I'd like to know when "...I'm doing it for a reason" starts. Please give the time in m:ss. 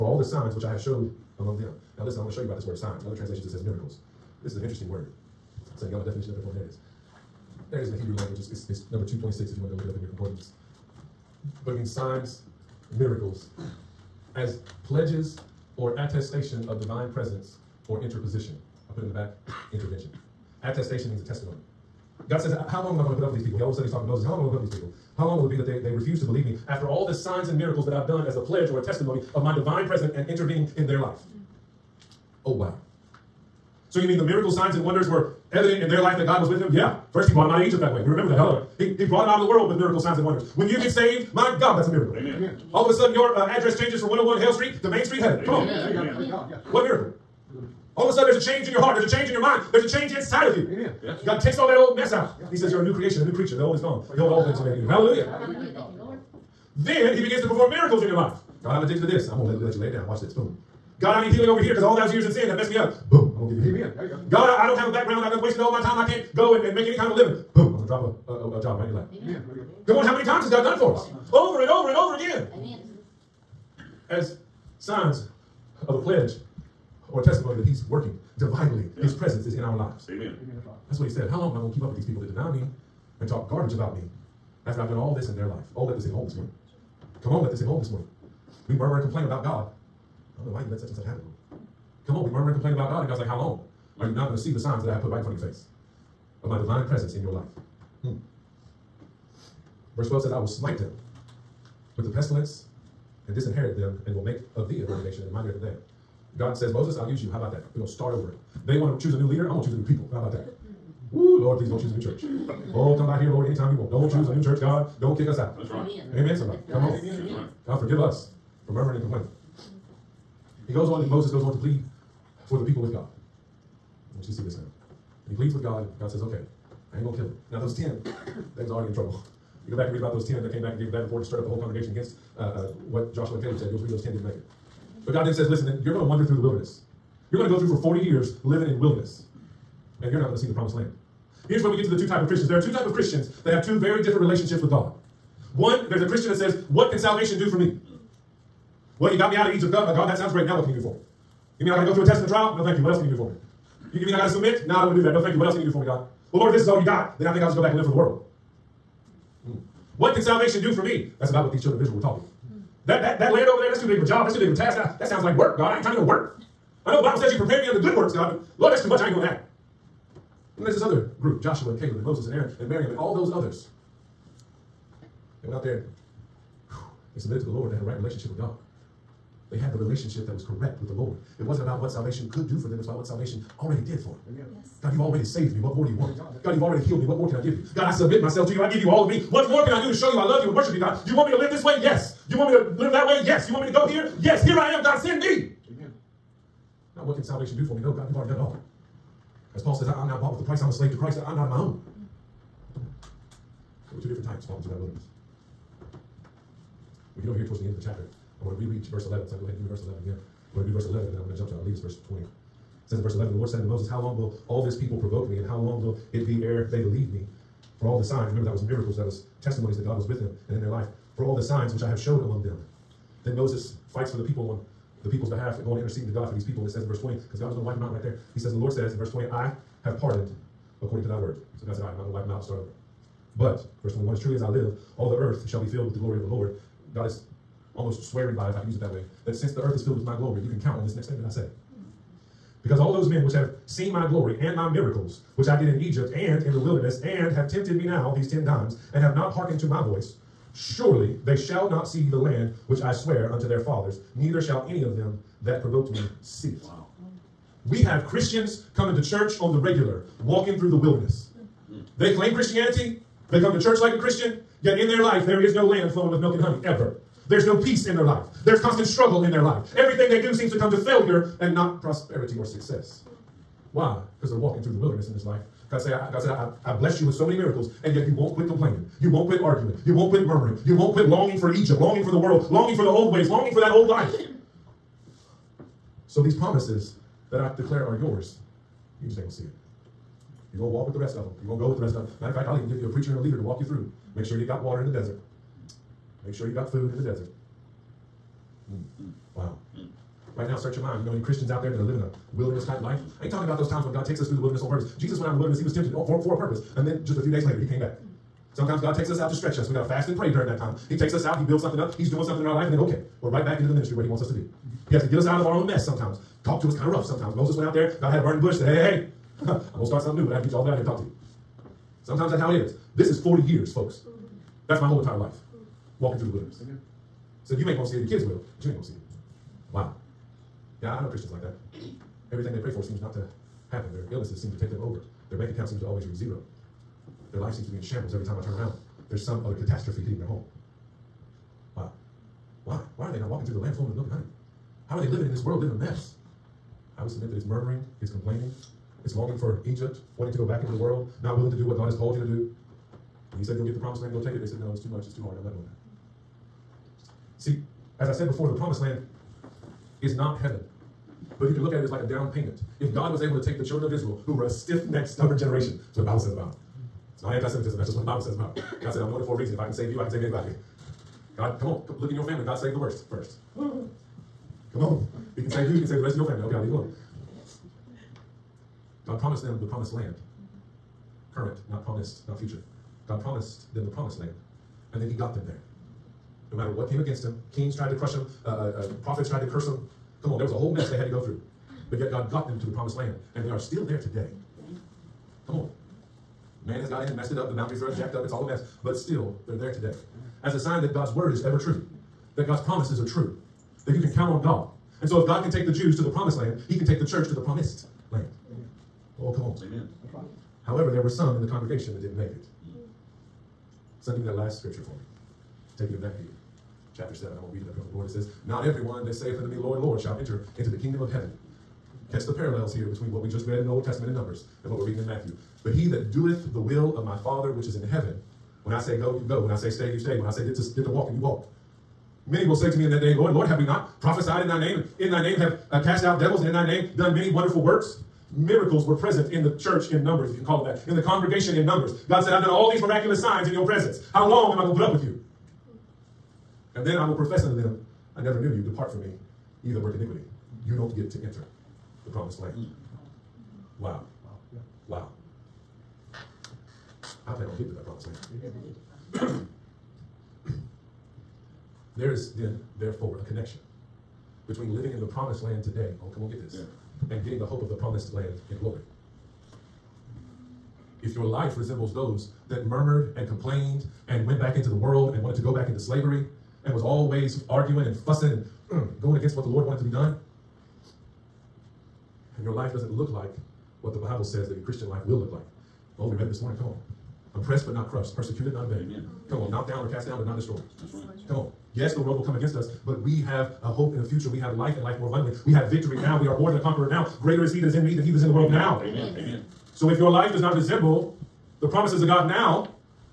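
6:09.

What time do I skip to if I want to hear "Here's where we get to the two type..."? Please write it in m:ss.
2:21.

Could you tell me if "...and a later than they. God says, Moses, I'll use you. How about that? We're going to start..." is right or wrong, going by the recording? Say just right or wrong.
wrong.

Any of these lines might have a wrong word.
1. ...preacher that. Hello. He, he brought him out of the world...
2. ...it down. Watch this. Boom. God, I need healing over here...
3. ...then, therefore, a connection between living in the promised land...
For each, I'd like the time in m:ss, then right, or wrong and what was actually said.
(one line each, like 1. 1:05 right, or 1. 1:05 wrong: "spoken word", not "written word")
1. 0:38 wrong: "remember", not "preacher"
2. 0:59 right
3. 7:42 right.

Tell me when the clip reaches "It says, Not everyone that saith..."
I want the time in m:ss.
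6:58.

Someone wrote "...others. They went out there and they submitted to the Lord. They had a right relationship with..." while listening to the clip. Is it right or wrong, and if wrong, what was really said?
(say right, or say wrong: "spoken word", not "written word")
right.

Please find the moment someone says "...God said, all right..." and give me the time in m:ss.
3:51.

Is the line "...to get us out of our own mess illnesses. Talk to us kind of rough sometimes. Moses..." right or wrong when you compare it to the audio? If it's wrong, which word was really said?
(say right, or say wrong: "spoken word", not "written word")
wrong: "sometimes", not "illnesses".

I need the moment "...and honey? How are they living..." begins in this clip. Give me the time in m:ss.
5:44.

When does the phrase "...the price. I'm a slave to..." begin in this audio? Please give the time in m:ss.
3:20.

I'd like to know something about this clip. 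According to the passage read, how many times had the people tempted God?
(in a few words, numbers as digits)
10.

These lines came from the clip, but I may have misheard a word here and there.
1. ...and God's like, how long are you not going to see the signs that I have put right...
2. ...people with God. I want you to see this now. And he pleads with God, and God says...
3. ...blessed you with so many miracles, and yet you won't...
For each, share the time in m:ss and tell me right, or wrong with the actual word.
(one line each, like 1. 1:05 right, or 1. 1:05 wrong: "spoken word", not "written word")
1. 1:33 right
2. 2:02 right
3. 4:36 right.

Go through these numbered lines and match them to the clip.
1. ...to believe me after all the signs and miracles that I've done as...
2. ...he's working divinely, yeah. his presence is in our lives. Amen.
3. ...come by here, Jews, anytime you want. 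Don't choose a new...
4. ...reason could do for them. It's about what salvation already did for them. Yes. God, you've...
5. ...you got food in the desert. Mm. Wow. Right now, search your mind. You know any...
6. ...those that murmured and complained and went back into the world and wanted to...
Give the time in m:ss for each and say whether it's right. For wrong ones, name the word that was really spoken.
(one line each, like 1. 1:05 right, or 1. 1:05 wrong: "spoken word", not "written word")
1. 0:26 right
2. 1:17 right
3. 1:52 wrong: "Lord", not "Jews"
4. 3:01 wrong: "salvation", not "reason"
5. 4:56 right
6. 7:51 right.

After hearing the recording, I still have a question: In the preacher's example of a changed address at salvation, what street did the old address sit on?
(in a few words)
Hale Street.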